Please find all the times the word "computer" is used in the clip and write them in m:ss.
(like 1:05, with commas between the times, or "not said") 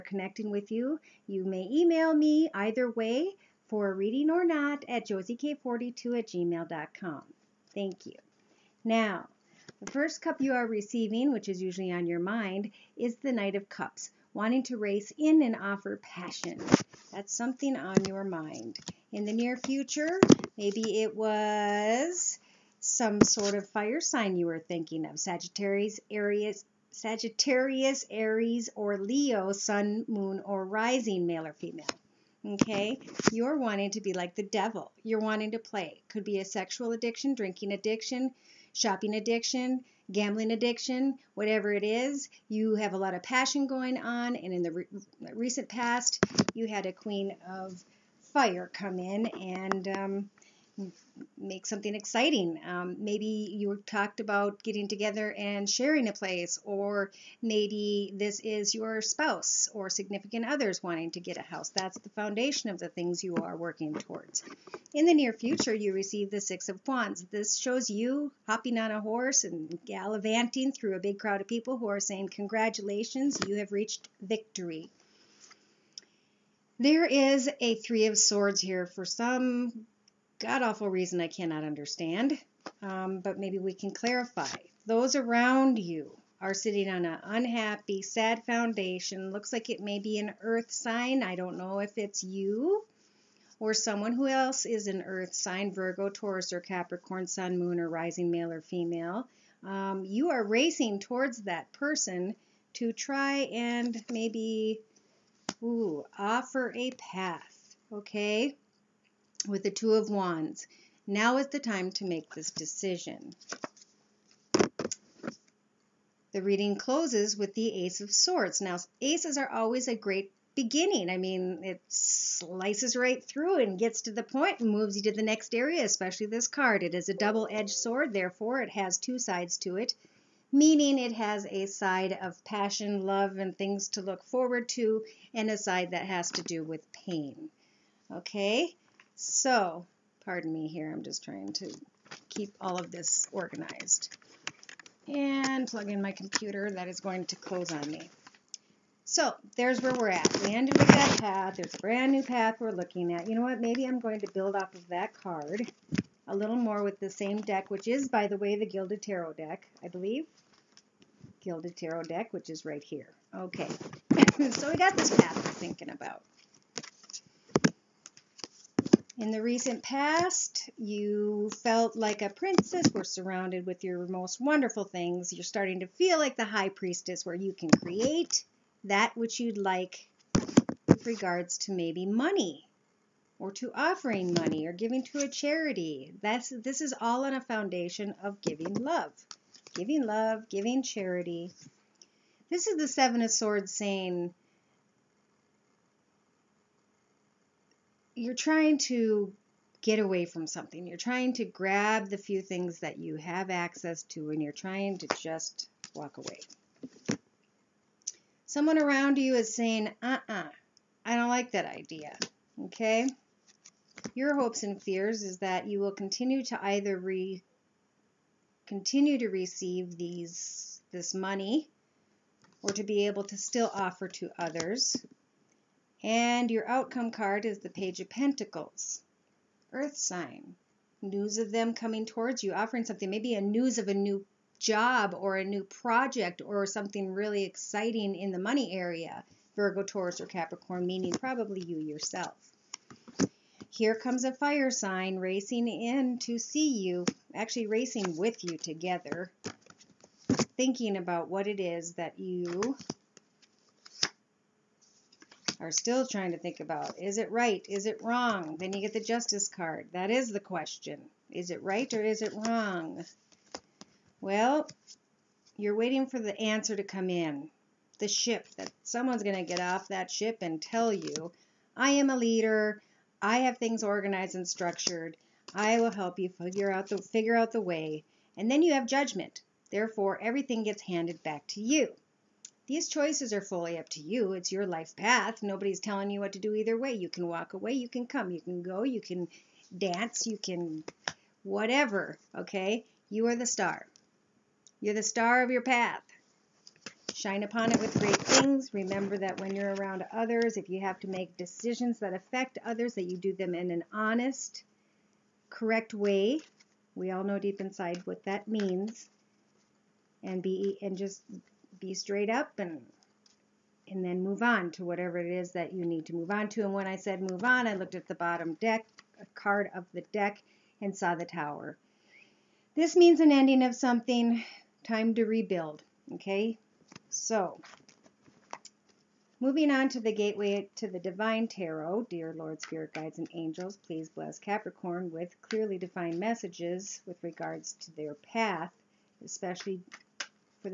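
2:26.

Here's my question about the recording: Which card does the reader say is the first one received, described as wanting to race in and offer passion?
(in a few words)
Knight of Cups.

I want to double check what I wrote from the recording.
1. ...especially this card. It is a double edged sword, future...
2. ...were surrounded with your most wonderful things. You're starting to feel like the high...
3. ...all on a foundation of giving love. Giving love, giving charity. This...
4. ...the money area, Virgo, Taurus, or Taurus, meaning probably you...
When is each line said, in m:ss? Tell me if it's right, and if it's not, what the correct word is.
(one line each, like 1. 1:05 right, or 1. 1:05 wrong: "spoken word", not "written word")
1. 2:05 wrong: "therefore", not "future"
2. 2:52 right
3. 3:06 right
4. 3:58 wrong: "Capricorn", not "Taurus".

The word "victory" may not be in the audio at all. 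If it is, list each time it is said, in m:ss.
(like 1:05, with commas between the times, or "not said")
1:14.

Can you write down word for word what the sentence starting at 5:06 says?
We all know deep inside what that means.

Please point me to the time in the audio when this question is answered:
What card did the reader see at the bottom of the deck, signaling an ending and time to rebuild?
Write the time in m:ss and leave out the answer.
5:21.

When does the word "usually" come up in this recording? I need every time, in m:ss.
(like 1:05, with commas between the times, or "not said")
0:11.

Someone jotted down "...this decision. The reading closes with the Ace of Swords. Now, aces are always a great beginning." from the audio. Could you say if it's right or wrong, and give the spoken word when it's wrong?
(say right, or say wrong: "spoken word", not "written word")
right.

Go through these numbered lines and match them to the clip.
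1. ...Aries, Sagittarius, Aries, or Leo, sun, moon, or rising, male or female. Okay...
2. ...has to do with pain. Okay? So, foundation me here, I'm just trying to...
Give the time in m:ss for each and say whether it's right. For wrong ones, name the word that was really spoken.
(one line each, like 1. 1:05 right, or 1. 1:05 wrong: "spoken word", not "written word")
1. 0:26 right
2. 2:16 wrong: "pardon", not "foundation".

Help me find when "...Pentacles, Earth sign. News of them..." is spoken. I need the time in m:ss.
3:48.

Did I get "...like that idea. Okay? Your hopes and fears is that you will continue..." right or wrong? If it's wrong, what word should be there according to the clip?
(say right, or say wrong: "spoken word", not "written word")
right.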